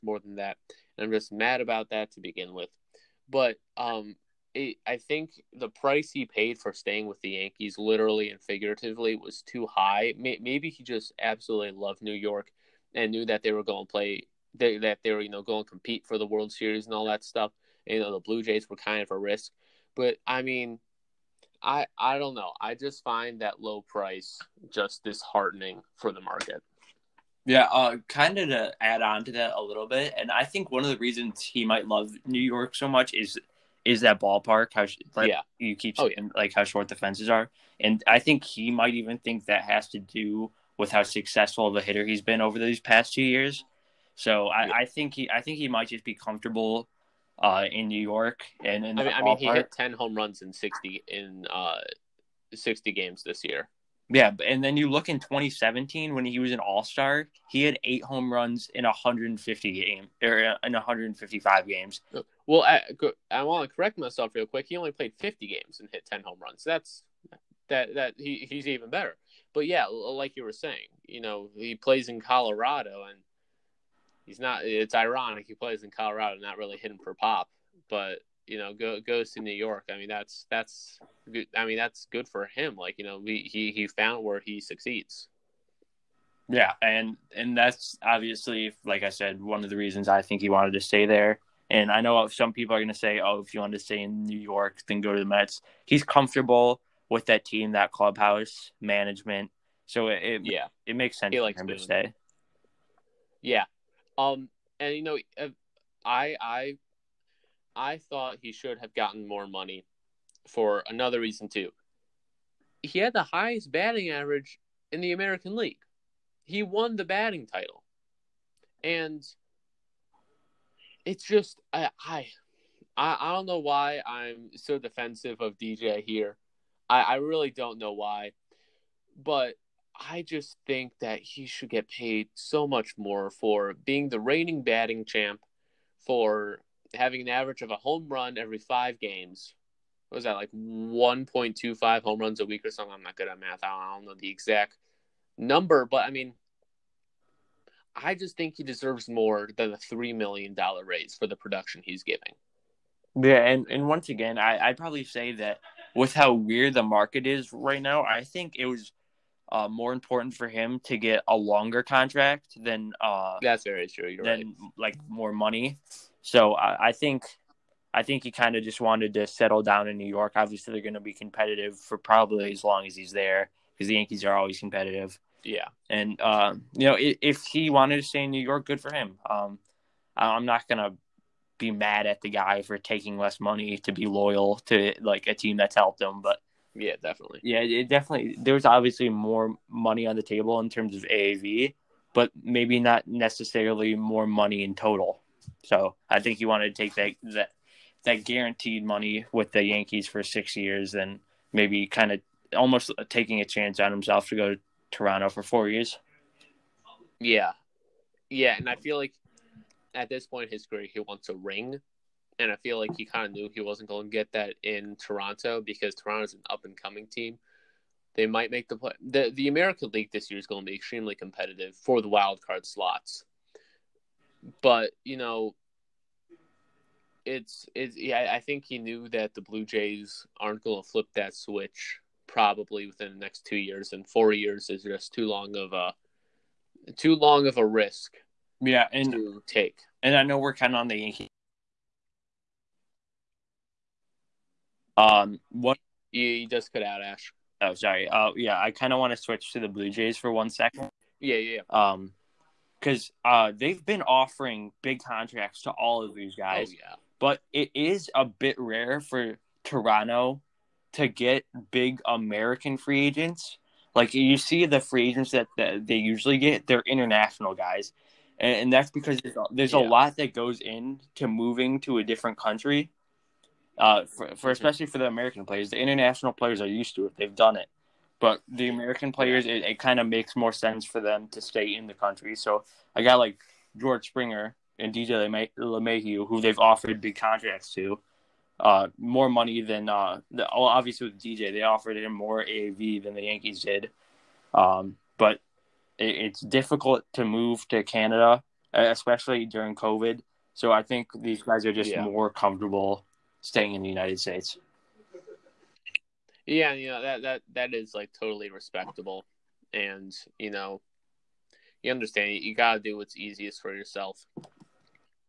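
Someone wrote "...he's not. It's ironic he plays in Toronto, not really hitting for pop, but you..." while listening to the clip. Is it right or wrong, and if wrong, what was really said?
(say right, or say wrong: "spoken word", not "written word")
wrong: "Colorado", not "Toronto".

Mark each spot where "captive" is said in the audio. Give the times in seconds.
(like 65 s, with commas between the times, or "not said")
not said.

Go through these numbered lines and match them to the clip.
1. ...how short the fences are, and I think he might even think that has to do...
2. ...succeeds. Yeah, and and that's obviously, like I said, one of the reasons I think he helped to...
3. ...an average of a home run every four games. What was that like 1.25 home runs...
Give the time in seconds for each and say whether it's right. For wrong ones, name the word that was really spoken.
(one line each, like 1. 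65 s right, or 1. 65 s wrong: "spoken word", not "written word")
1. 36 s right
2. 84 s wrong: "wanted", not "helped"
3. 137 s wrong: "five", not "four".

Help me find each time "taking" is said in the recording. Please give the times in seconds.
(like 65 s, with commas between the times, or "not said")
182 s, 203 s.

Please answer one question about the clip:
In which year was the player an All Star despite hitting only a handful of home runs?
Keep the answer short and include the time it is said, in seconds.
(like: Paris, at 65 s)
2017, at 55 s.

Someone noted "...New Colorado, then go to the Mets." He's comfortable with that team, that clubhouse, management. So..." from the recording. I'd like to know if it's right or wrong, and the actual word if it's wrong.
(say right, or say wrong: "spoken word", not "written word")
wrong: "York", not "Colorado".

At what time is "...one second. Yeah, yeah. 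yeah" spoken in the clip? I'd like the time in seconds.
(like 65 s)
250 s.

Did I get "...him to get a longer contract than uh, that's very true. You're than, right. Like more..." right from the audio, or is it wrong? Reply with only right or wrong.
right.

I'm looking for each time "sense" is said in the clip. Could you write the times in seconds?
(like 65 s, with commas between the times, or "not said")
101 s, 280 s.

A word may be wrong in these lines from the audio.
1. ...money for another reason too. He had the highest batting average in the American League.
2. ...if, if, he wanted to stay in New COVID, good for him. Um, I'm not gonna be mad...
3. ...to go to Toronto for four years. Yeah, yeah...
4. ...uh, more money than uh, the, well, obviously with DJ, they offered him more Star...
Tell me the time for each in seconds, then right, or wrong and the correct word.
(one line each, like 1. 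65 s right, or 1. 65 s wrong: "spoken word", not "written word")
1. 109 s right
2. 176 s wrong: "York", not "COVID"
3. 204 s right
4. 288 s wrong: "AAV", not "Star".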